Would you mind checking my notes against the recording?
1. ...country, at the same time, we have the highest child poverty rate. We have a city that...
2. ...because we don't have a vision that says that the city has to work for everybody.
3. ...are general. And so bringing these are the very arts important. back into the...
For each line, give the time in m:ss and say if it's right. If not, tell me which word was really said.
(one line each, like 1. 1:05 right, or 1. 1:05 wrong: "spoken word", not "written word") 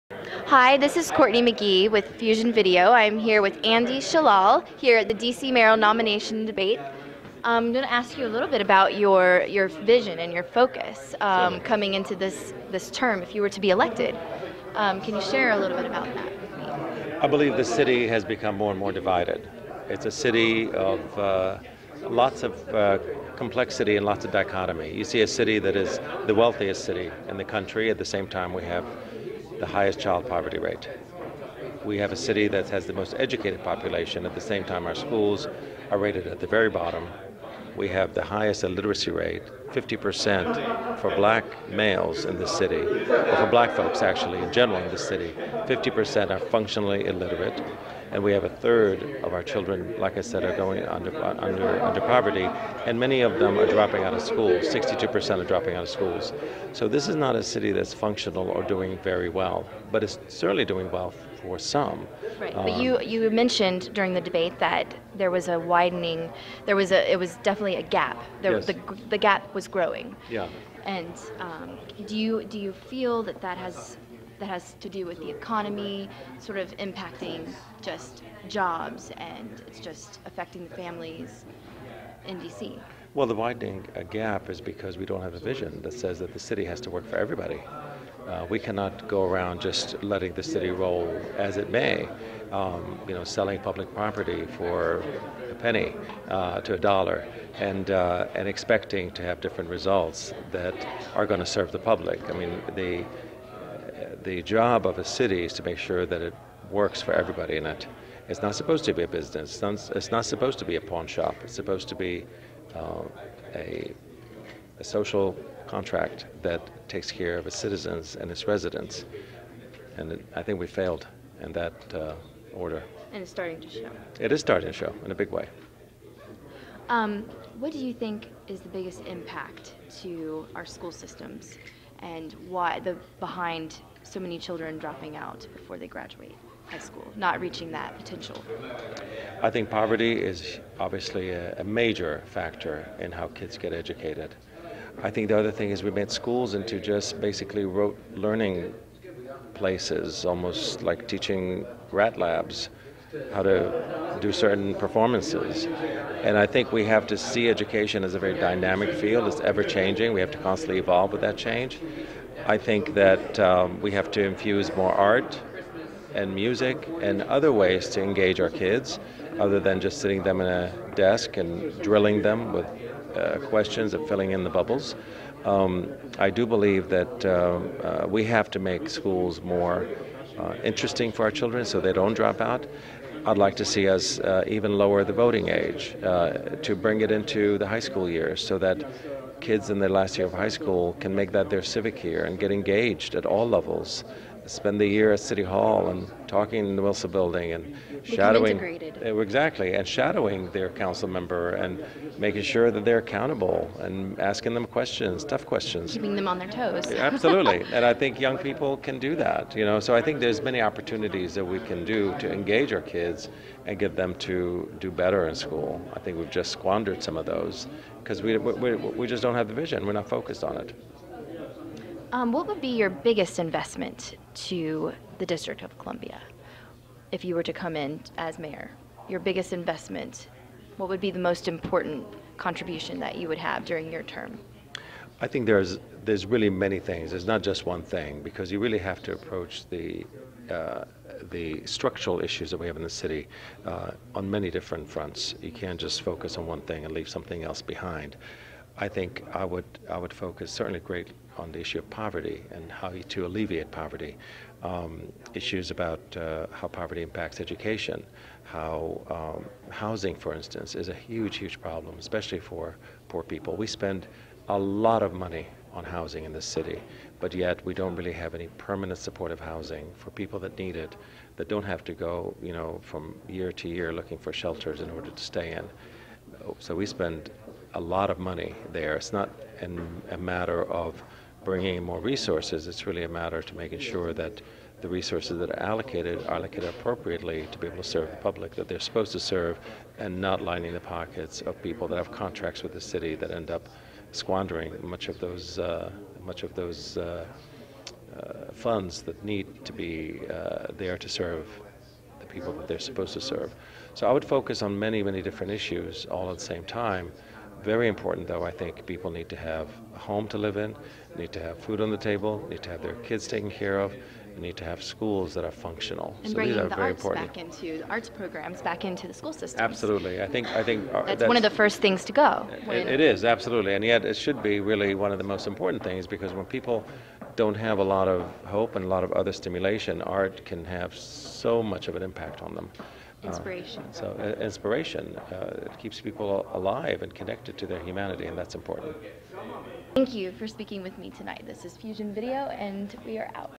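1. 0:27 right
2. 1:24 right
3. 5:15 wrong: "functional", not "general".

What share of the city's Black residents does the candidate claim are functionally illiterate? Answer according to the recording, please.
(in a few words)
50%.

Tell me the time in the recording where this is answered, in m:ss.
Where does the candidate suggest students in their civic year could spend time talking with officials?
3:16.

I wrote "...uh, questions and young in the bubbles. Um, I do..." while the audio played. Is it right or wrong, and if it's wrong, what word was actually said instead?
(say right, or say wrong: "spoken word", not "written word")
wrong: "filling", not "young".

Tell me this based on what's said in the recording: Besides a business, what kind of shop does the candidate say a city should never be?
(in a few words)
pawn shop.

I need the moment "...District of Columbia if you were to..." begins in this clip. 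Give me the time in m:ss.
3:45.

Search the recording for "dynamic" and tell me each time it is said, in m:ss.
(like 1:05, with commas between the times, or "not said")
2:38.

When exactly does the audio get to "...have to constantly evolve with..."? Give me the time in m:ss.
2:40.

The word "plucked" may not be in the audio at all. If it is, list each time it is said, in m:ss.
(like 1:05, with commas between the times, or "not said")
not said.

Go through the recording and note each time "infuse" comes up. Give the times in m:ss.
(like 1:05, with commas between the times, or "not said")
2:44.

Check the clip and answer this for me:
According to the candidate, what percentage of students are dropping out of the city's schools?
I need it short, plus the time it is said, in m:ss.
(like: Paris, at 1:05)
62%, at 0:54.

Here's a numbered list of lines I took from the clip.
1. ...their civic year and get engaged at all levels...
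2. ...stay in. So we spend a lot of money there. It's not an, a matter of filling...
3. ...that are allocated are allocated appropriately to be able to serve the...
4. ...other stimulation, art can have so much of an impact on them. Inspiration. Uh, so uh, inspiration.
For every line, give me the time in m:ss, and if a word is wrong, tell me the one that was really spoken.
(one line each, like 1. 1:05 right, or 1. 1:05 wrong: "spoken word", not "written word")
1. 3:11 right
2. 4:35 wrong: "bringing", not "filling"
3. 4:45 right
4. 5:29 right.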